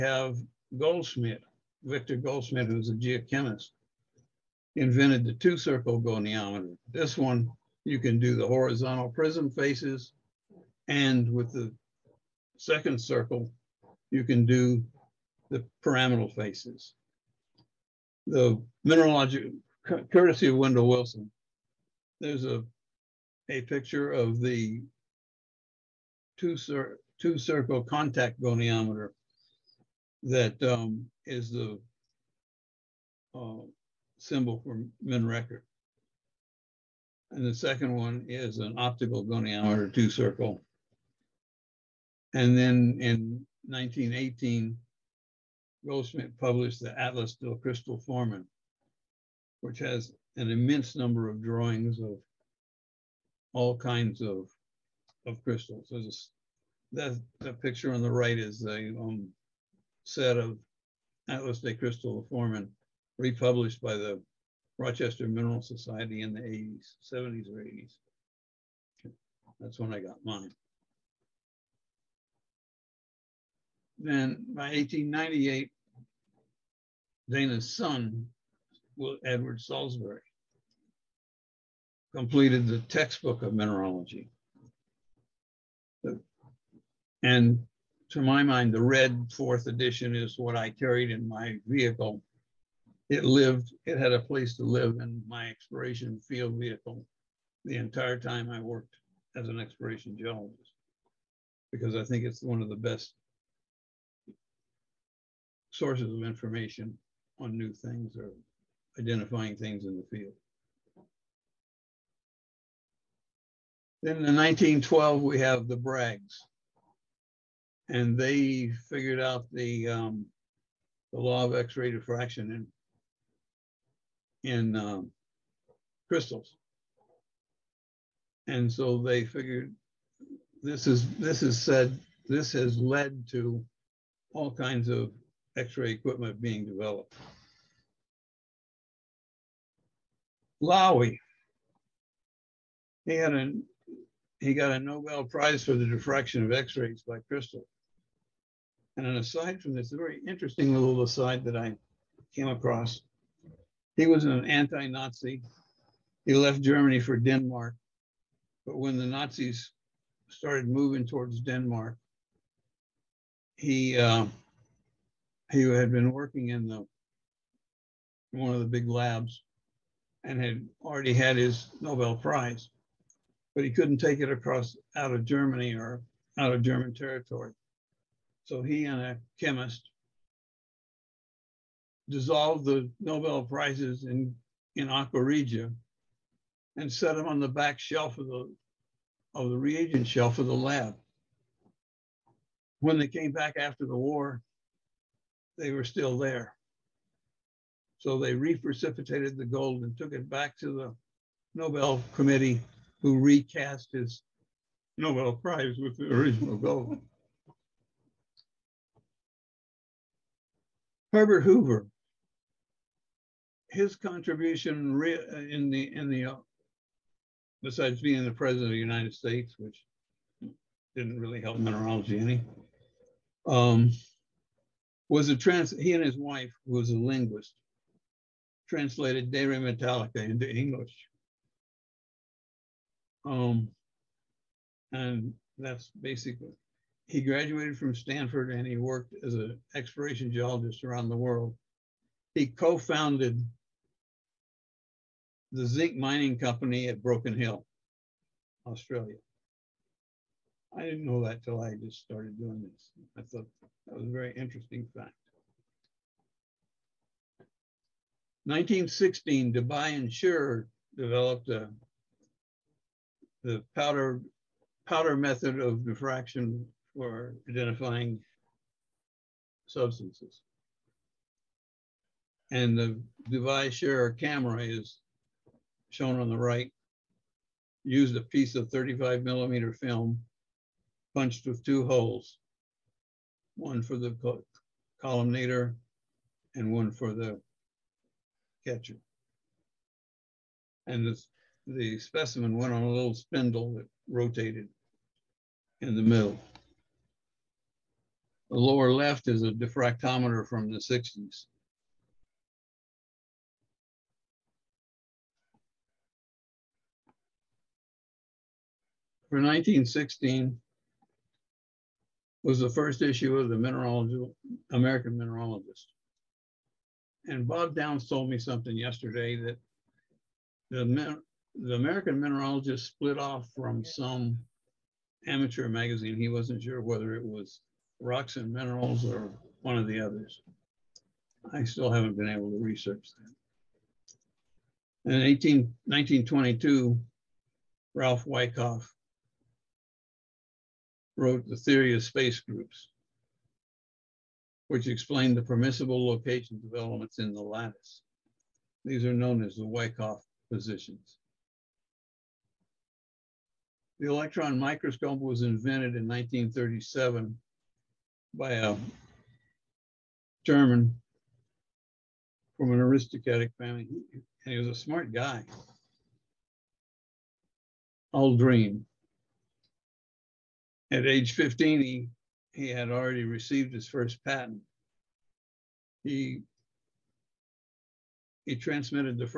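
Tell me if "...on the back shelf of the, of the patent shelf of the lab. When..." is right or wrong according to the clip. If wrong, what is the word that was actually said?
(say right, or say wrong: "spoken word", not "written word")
wrong: "reagent", not "patent".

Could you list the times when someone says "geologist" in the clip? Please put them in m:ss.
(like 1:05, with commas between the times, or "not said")
1:40, 4:00.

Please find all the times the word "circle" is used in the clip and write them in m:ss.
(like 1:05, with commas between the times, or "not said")
0:05, 0:13, 0:27, 0:40.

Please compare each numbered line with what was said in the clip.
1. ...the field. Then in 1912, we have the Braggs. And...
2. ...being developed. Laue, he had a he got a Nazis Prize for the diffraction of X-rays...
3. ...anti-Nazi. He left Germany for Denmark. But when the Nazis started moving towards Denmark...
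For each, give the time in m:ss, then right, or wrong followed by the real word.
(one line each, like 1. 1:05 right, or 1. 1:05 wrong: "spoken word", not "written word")
1. 1:49 right
2. 2:16 wrong: "Nobel", not "Nazis"
3. 2:34 right.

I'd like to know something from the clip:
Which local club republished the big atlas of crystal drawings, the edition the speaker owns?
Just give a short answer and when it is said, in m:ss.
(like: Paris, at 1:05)
Rochester Mineral Society, at 1:04.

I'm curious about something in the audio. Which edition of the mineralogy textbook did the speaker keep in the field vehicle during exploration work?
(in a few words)
red fourth edition.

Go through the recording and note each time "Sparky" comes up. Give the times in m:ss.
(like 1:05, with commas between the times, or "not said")
not said.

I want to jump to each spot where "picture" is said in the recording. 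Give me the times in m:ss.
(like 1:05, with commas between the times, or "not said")
0:23, 0:57.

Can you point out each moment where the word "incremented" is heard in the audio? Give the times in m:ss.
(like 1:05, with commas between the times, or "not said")
not said.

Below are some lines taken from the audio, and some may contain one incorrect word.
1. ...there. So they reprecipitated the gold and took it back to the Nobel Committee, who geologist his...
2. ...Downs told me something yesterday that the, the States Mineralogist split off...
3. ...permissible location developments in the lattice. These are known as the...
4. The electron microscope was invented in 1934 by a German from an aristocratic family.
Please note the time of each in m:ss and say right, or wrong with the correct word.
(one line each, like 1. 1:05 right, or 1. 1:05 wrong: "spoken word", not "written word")
1. 3:16 wrong: "recast", not "geologist"
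2. 5:17 wrong: "American", not "States"
3. 5:45 right
4. 5:54 wrong: "1937", not "1934".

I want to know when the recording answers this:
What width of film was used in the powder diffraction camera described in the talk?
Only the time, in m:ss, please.
4:38.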